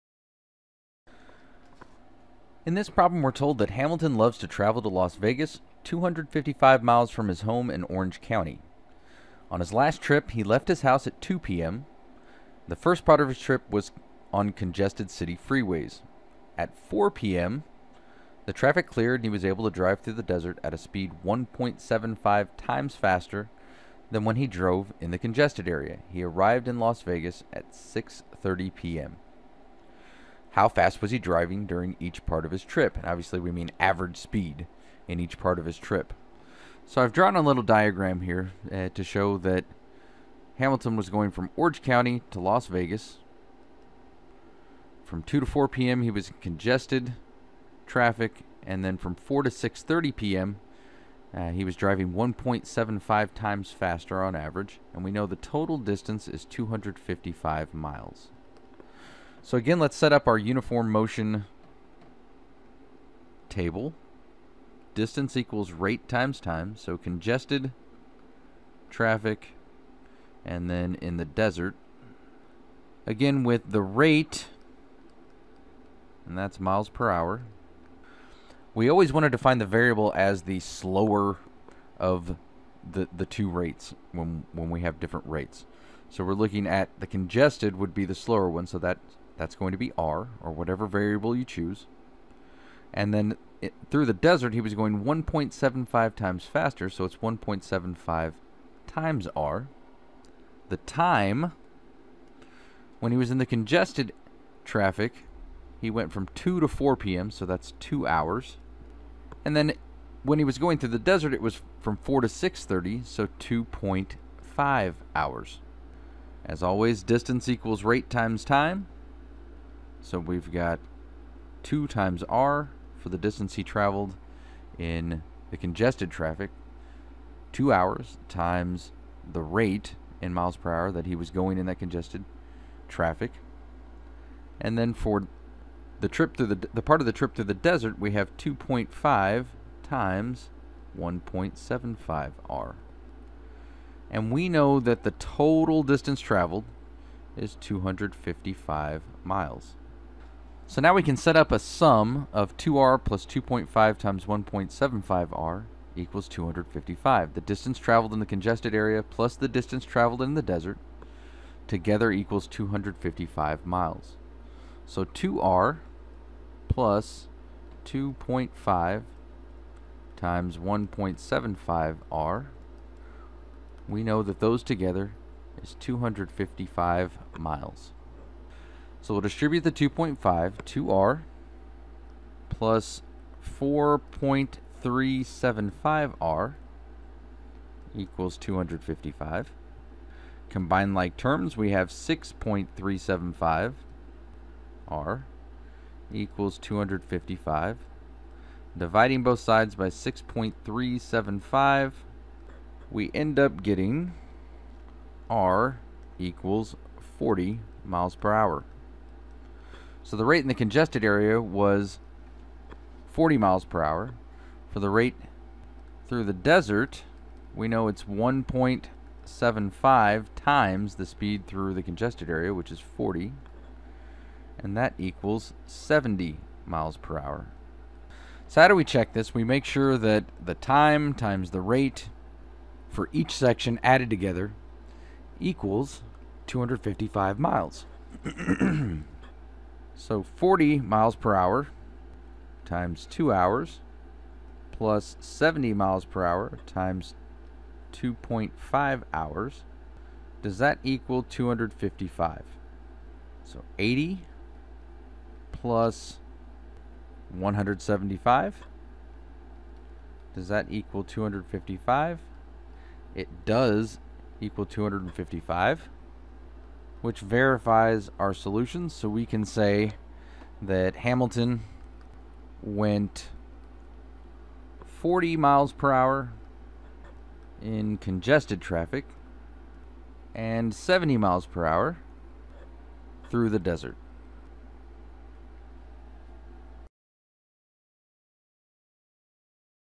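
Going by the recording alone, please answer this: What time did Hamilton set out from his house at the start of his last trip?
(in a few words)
2 p.m.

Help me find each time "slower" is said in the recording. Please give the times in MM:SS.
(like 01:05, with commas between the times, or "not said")
01:20, 01:28.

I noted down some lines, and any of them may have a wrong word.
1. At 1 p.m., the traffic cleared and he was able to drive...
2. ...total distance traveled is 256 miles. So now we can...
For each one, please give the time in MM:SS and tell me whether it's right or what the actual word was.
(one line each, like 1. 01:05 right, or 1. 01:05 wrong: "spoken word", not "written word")
1. 00:16 wrong: "4", not "1"
2. 02:25 wrong: "255", not "256".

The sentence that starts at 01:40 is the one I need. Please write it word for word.
The time, when he was in the congested traffic, he went from 2 to 4 p.m., so that's two hours.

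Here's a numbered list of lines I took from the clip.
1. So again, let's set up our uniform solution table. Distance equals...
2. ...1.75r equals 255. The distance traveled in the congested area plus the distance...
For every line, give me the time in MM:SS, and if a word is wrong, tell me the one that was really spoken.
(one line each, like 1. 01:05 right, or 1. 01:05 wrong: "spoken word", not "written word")
1. 00:59 wrong: "motion", not "solution"
2. 02:34 right.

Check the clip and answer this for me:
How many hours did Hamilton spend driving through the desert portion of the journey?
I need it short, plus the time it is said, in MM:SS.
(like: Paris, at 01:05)
2.5 hours, at 01:53.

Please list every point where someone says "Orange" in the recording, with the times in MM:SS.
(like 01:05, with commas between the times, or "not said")
00:07, 00:41.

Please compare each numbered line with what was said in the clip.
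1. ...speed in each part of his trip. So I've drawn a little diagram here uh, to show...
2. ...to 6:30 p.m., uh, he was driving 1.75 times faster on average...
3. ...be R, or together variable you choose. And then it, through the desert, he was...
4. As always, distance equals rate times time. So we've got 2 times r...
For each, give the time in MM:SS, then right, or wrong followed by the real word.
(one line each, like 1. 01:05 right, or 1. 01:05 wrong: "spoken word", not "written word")
1. 00:34 right
2. 00:49 right
3. 01:29 wrong: "whatever", not "together"
4. 01:56 right.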